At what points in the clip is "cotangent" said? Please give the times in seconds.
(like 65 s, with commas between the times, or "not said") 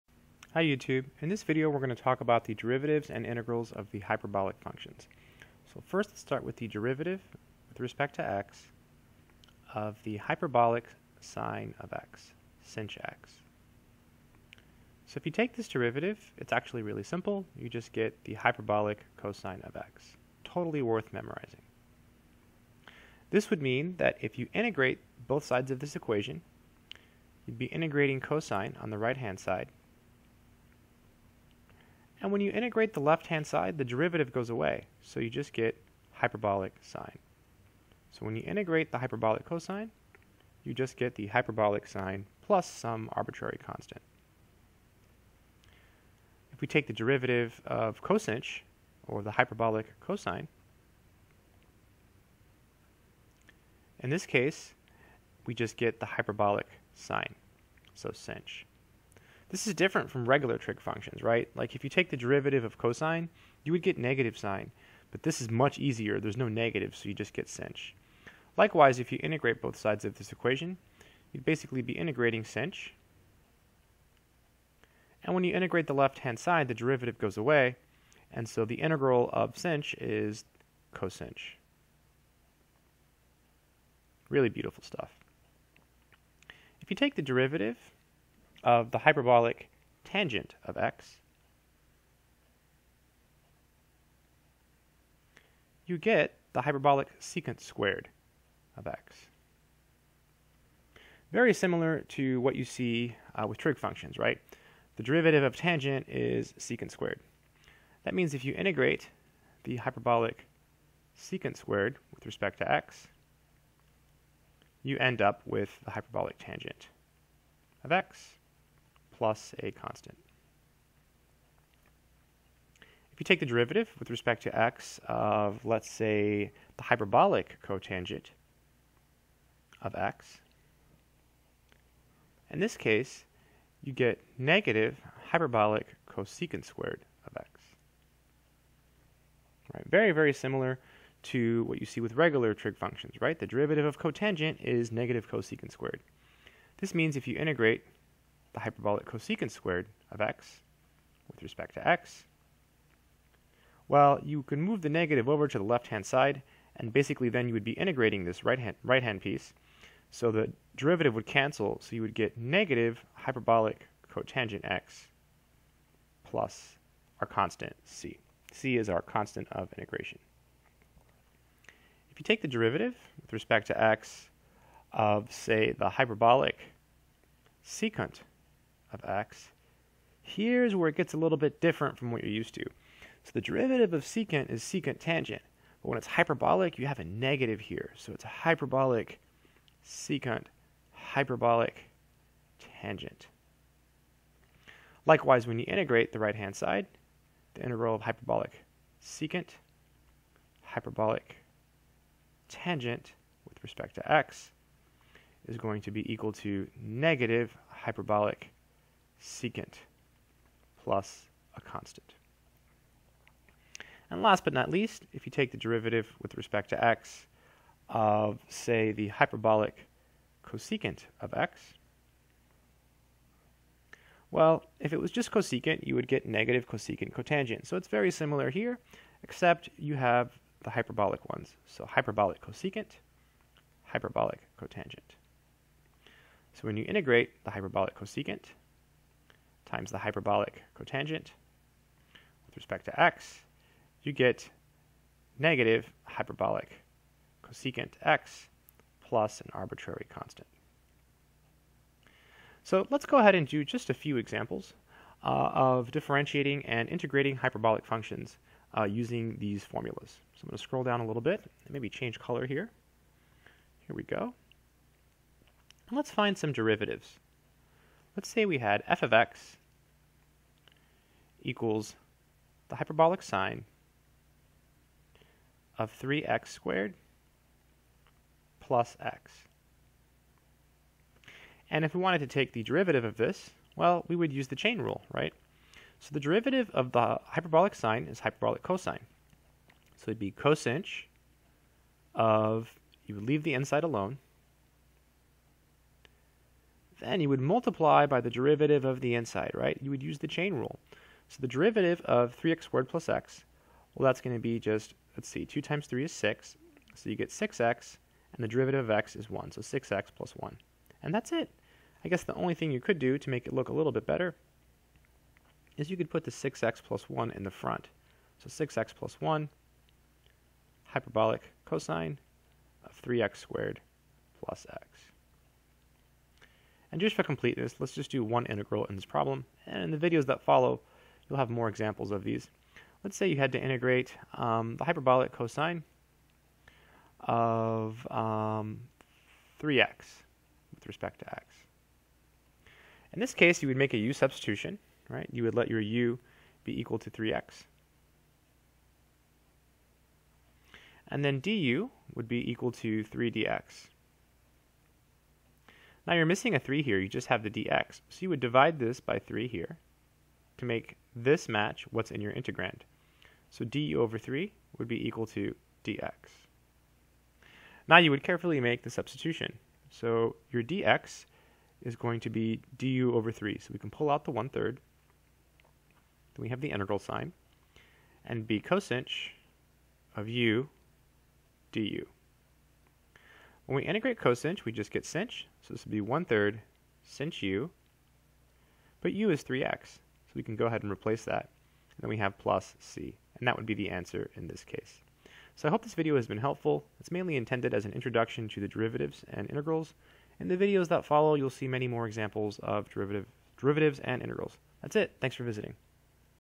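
127 s, 143 s, 164 s, 227 s, 234 s, 240 s.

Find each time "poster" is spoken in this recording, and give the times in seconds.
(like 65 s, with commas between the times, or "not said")
not said.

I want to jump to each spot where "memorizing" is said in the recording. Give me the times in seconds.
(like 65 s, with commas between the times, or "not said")
21 s.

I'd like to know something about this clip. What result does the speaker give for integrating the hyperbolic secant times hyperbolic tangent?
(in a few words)
negative hyperbolic secant.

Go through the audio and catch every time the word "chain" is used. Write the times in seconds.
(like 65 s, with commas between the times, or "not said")
284 s, 300 s.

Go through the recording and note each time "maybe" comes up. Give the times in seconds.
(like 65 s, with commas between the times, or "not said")
261 s.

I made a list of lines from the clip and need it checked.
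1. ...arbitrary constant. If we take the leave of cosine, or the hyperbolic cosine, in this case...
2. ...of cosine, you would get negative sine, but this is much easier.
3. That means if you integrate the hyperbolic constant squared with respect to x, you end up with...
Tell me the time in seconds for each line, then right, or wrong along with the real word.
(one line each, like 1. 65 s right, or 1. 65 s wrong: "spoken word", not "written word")
1. 43 s wrong: "derivative", not "leave"
2. 62 s right
3. 108 s wrong: "secant", not "constant".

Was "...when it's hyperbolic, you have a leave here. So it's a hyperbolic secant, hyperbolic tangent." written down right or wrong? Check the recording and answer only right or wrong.
wrong.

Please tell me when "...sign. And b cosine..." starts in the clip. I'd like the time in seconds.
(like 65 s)
376 s.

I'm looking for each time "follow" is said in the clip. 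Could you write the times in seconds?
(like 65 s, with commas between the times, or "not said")
330 s, 401 s.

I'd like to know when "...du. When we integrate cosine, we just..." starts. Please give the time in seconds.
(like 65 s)
381 s.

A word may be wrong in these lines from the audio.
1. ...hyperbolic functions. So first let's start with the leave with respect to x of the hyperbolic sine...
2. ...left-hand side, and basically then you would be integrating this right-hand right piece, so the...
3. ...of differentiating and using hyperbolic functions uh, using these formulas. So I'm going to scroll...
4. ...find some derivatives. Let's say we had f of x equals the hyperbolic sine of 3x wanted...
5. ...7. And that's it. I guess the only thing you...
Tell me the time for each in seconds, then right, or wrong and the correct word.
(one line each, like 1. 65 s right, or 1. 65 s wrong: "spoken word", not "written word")
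1. 4 s wrong: "derivative", not "leave"
2. 155 s right
3. 255 s wrong: "integrating", not "using"
4. 266 s wrong: "squared", not "wanted"
5. 310 s wrong: "1", not "7".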